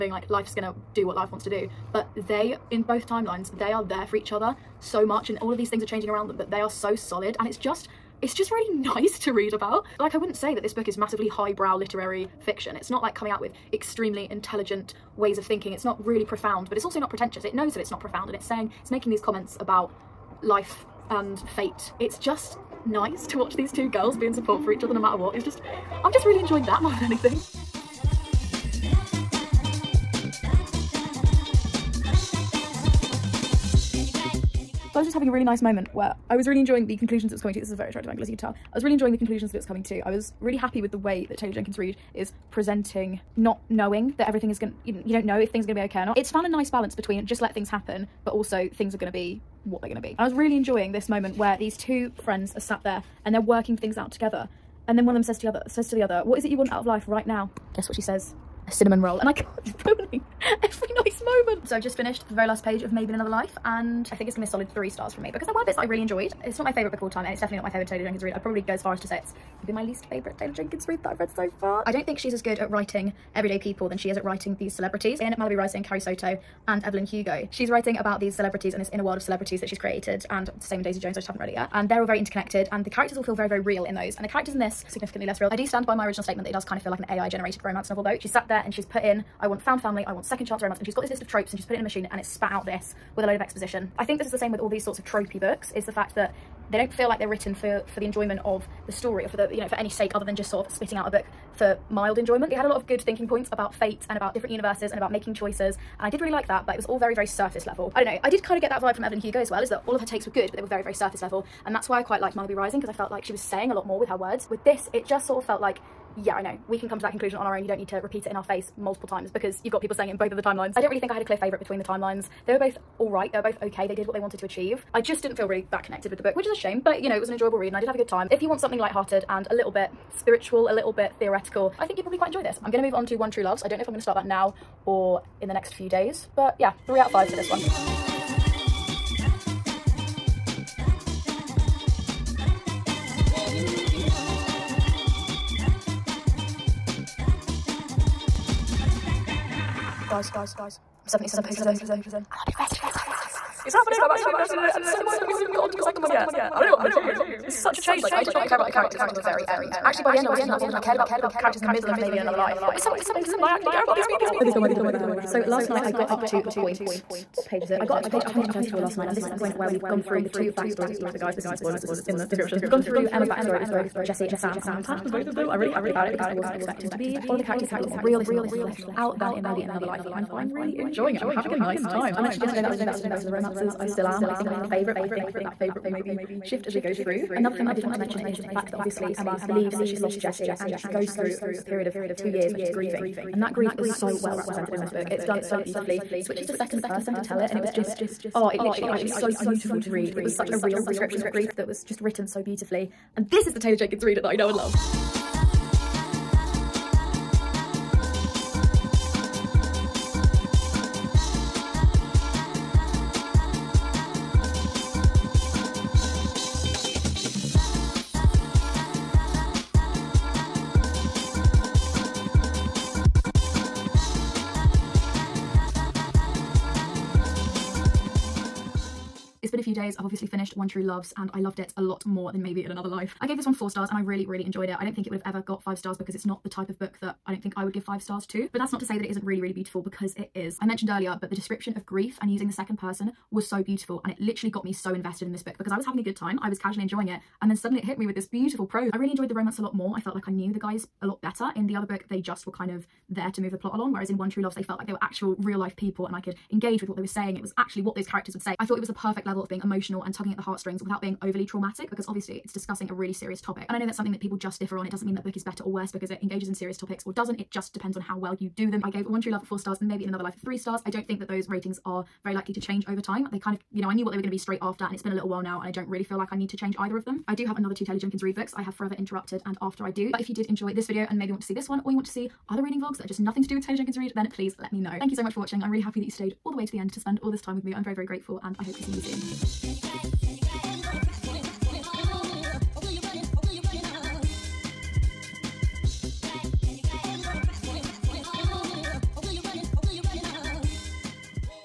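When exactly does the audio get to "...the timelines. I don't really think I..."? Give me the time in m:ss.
2:00.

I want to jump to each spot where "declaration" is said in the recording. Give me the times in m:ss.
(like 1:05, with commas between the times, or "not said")
not said.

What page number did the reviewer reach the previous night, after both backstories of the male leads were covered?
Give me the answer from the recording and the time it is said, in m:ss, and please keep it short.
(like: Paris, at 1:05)
134, at 2:48.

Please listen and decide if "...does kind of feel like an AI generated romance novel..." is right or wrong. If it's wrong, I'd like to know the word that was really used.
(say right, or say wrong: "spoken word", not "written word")
right.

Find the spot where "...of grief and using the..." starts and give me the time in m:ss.
4:01.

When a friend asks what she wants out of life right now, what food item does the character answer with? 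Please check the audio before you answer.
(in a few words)
a cinnamon roll.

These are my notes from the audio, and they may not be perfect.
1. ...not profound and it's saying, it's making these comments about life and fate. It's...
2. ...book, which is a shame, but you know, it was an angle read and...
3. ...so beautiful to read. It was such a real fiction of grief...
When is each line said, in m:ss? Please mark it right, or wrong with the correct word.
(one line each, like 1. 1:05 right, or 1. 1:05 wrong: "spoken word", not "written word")
1. 0:17 right
2. 2:06 wrong: "enjoyable", not "angle"
3. 3:19 wrong: "description", not "fiction".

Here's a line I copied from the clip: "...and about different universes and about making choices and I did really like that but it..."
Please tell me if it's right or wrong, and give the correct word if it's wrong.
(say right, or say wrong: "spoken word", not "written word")
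right.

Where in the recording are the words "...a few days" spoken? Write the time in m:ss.
3:49.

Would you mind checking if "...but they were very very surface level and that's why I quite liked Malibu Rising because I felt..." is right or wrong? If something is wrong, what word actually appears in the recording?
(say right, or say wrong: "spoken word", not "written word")
right.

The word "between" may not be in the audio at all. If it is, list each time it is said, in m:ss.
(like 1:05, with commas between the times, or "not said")
0:46, 2:01.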